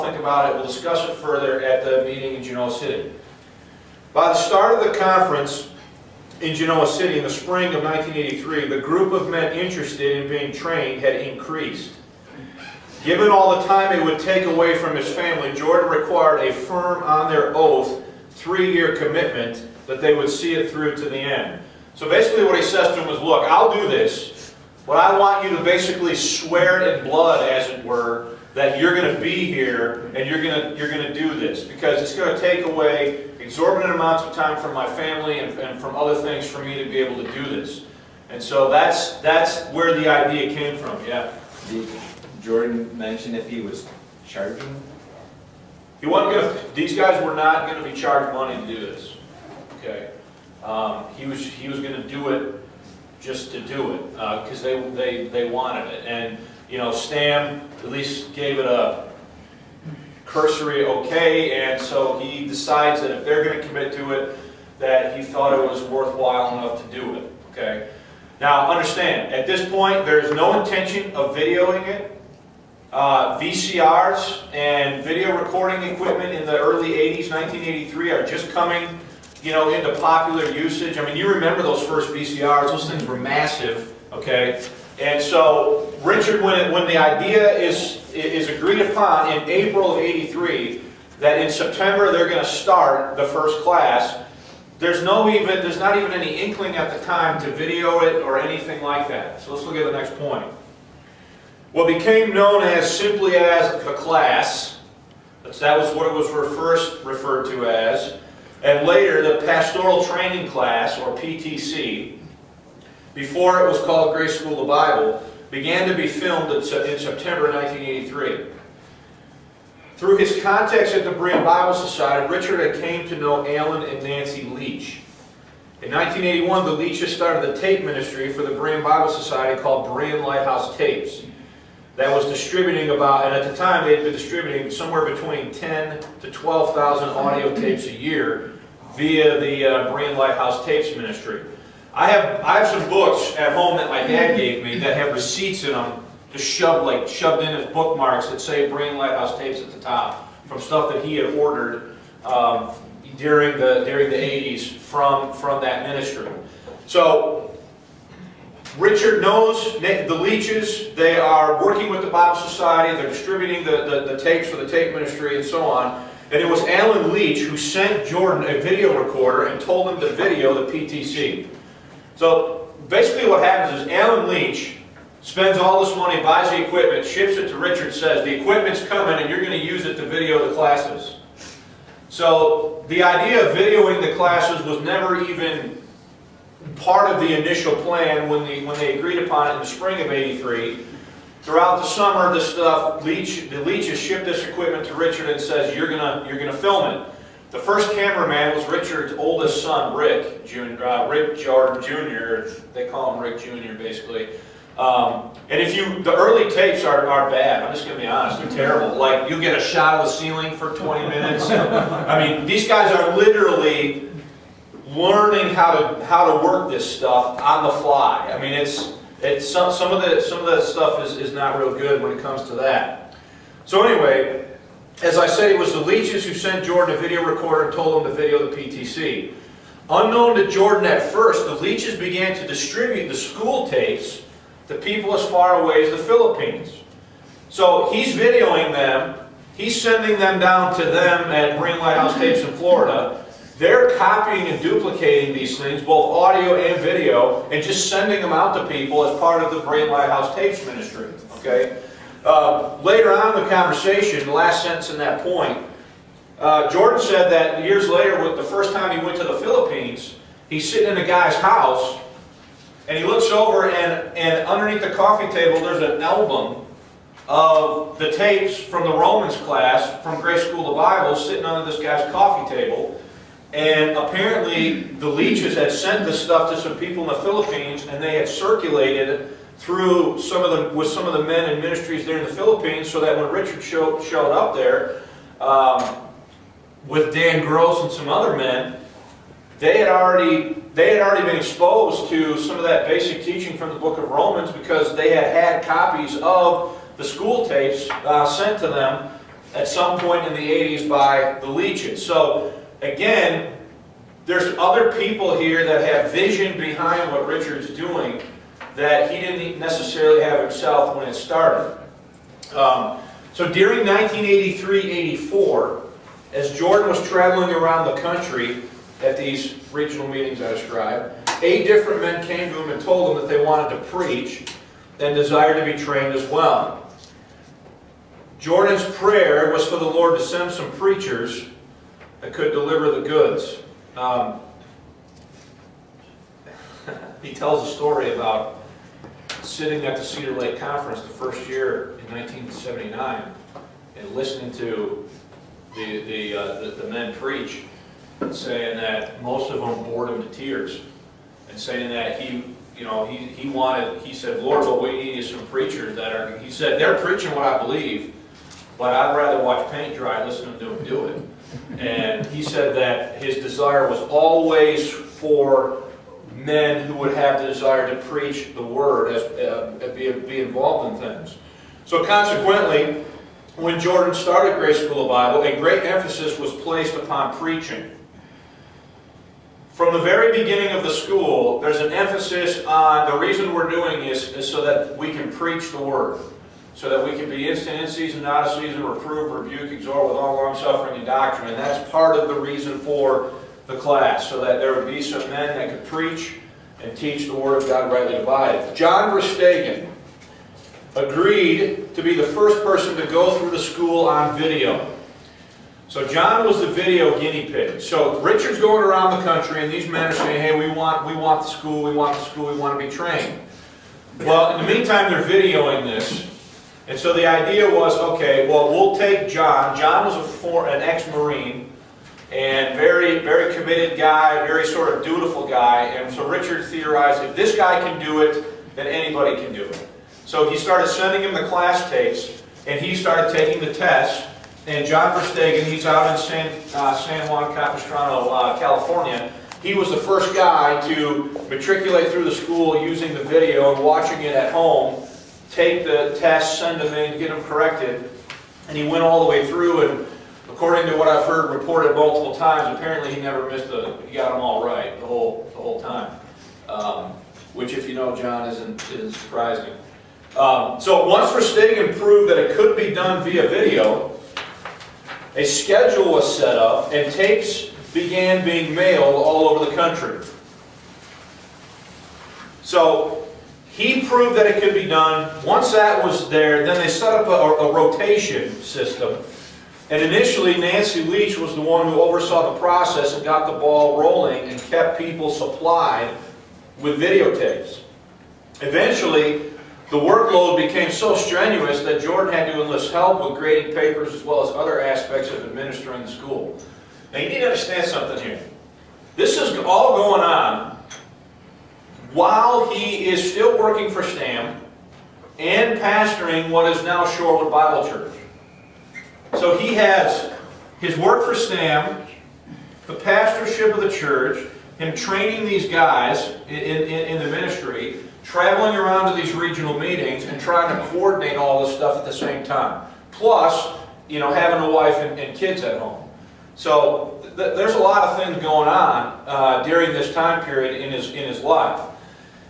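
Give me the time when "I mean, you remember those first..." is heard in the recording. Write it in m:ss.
1:20.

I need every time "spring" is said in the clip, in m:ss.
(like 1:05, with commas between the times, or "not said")
0:07, 3:09.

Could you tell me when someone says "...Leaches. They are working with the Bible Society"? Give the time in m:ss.
2:40.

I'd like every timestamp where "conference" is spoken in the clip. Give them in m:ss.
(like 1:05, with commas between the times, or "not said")
0:04, 5:40.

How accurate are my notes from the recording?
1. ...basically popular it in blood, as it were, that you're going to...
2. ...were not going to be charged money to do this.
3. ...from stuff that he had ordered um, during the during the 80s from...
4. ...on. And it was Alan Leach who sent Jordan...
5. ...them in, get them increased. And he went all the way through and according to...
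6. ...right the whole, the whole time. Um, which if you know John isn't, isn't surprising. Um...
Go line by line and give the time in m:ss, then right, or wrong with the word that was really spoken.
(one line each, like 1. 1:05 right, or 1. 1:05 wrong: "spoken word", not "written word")
1. 0:25 wrong: "swear", not "popular"
2. 0:47 right
3. 2:30 right
4. 2:45 right
5. 7:26 wrong: "corrected", not "increased"
6. 7:34 right.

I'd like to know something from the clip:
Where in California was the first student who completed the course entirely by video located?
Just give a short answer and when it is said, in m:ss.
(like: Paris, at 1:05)
San Juan Capistrano, at 7:16.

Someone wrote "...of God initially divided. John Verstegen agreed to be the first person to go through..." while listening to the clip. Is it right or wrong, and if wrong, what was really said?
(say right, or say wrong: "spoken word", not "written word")
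wrong: "rightly", not "initially".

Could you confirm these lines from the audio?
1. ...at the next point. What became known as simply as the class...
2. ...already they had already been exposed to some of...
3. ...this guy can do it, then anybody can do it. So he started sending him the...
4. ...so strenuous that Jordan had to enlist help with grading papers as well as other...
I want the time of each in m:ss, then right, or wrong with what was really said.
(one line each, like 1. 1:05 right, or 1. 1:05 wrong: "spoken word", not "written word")
1. 1:39 right
2. 4:49 right
3. 7:07 right
4. 8:10 right.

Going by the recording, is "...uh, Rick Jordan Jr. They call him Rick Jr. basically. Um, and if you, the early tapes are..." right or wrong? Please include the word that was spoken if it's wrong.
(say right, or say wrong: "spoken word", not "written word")
right.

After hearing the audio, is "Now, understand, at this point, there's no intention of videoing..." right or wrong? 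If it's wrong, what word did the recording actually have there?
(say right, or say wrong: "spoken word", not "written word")
right.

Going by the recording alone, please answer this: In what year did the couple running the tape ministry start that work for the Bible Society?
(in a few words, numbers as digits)
1981.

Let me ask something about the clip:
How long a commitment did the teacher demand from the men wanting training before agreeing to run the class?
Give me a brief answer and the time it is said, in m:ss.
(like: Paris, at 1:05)
3 years, at 0:18.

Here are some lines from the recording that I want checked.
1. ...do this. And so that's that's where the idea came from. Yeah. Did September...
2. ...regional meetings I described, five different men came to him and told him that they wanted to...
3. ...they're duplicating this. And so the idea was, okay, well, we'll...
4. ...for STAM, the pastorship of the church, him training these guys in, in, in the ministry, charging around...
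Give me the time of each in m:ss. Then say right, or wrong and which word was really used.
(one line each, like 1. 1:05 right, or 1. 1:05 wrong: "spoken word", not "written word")
1. 0:37 wrong: "Jordan", not "September"
2. 5:19 wrong: "eight", not "five"
3. 6:55 wrong: "videoing", not "duplicating"
4. 8:31 wrong: "traveling", not "charging".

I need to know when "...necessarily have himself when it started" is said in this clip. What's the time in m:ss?
5:09.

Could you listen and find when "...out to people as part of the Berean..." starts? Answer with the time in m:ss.
4:08.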